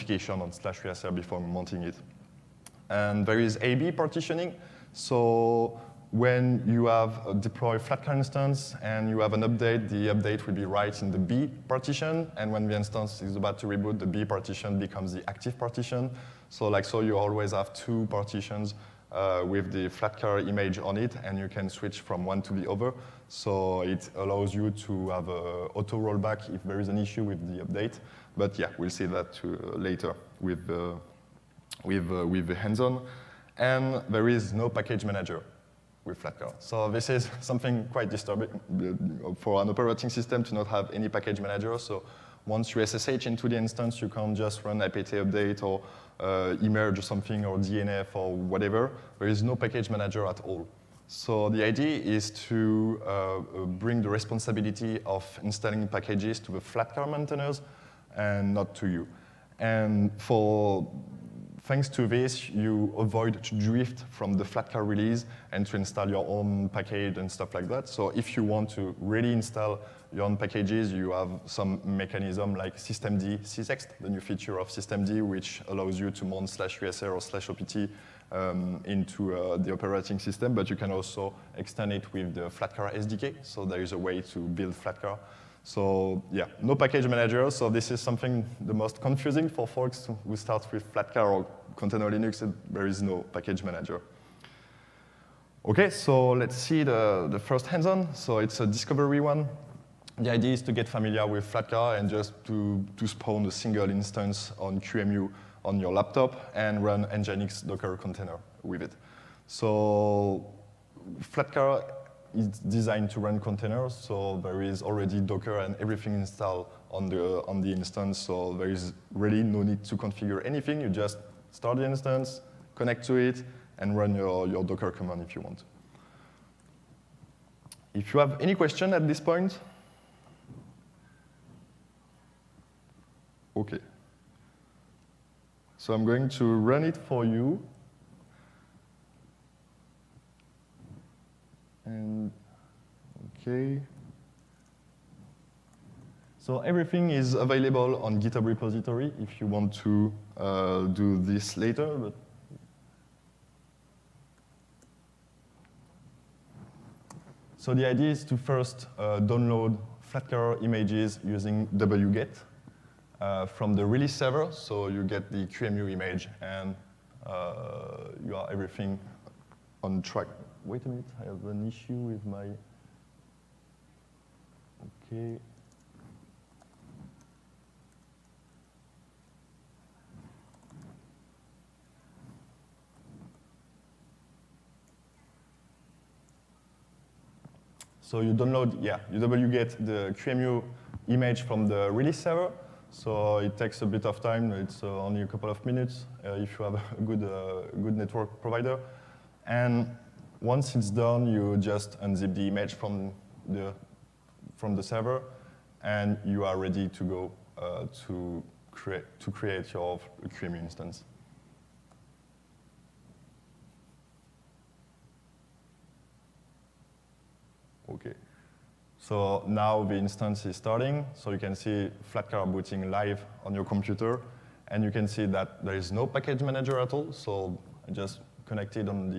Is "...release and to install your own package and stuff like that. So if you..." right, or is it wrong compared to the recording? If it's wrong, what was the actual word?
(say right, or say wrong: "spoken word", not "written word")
right.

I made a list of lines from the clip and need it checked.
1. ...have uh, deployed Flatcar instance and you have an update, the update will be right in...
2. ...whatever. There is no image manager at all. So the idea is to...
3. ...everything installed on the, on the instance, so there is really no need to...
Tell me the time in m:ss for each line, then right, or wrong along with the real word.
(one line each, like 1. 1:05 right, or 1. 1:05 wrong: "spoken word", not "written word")
1. 0:06 right
2. 0:48 wrong: "package", not "image"
3. 1:55 right.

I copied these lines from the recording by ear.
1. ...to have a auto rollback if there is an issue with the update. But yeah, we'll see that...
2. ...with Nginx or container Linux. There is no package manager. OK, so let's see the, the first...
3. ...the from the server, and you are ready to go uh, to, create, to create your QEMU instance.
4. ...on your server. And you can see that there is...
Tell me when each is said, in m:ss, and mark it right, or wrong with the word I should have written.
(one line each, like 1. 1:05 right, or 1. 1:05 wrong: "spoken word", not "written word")
1. 0:24 right
2. 1:30 wrong: "Flatcar", not "Nginx"
3. 3:23 right
4. 3:43 wrong: "computer", not "server".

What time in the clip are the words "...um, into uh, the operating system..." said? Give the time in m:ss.
1:18.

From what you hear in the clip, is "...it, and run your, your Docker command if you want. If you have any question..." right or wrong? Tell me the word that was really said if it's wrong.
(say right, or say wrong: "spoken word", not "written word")
right.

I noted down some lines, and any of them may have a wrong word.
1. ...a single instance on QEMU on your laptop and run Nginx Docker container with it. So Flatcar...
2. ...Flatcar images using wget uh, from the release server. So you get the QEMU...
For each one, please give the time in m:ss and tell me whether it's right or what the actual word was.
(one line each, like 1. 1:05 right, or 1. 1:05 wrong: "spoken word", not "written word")
1. 1:43 right
2. 2:40 right.